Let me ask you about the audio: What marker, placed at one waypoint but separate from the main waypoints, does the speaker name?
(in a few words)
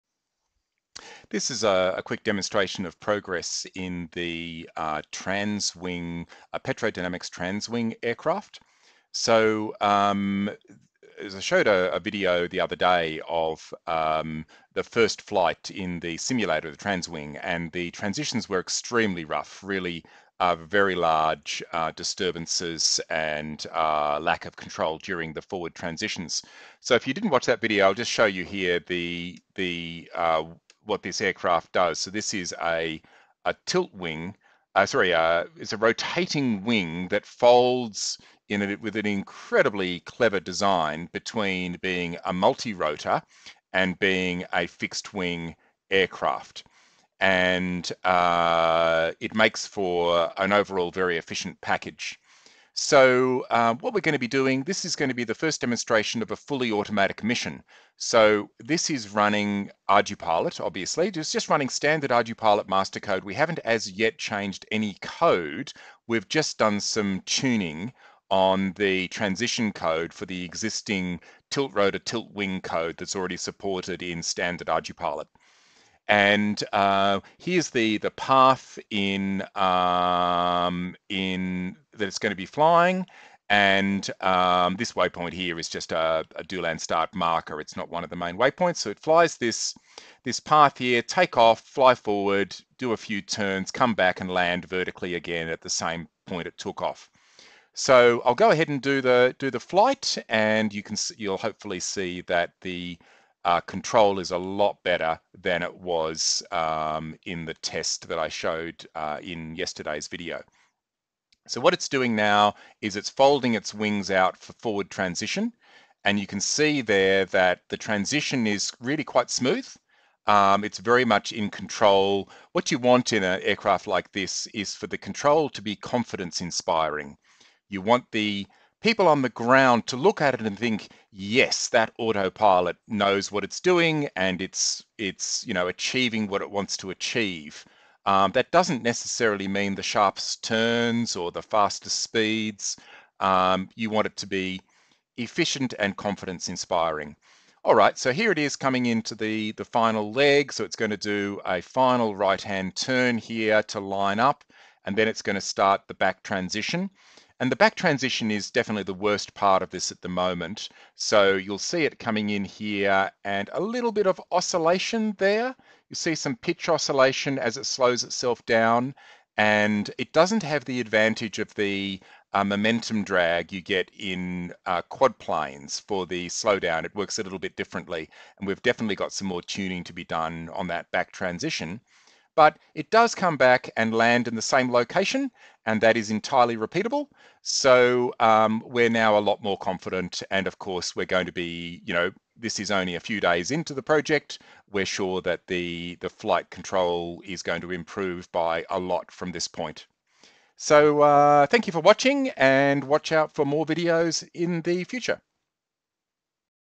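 DO_LAND_START.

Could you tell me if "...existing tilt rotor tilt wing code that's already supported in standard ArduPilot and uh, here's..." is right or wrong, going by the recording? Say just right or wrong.
right.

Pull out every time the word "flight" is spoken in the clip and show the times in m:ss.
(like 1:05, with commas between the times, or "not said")
0:15, 1:39, 3:16.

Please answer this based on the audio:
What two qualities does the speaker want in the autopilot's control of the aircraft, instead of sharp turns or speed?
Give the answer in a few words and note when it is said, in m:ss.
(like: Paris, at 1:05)
efficient and confidence inspiring, at 2:25.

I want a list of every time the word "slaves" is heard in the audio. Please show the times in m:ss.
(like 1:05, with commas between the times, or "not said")
not said.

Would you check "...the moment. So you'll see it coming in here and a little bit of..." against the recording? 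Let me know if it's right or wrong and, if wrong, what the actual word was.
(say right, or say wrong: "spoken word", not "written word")
right.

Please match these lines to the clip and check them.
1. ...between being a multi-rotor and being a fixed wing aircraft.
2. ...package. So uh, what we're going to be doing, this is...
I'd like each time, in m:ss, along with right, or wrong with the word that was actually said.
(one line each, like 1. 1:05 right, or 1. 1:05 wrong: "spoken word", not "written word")
1. 0:41 right
2. 0:51 right.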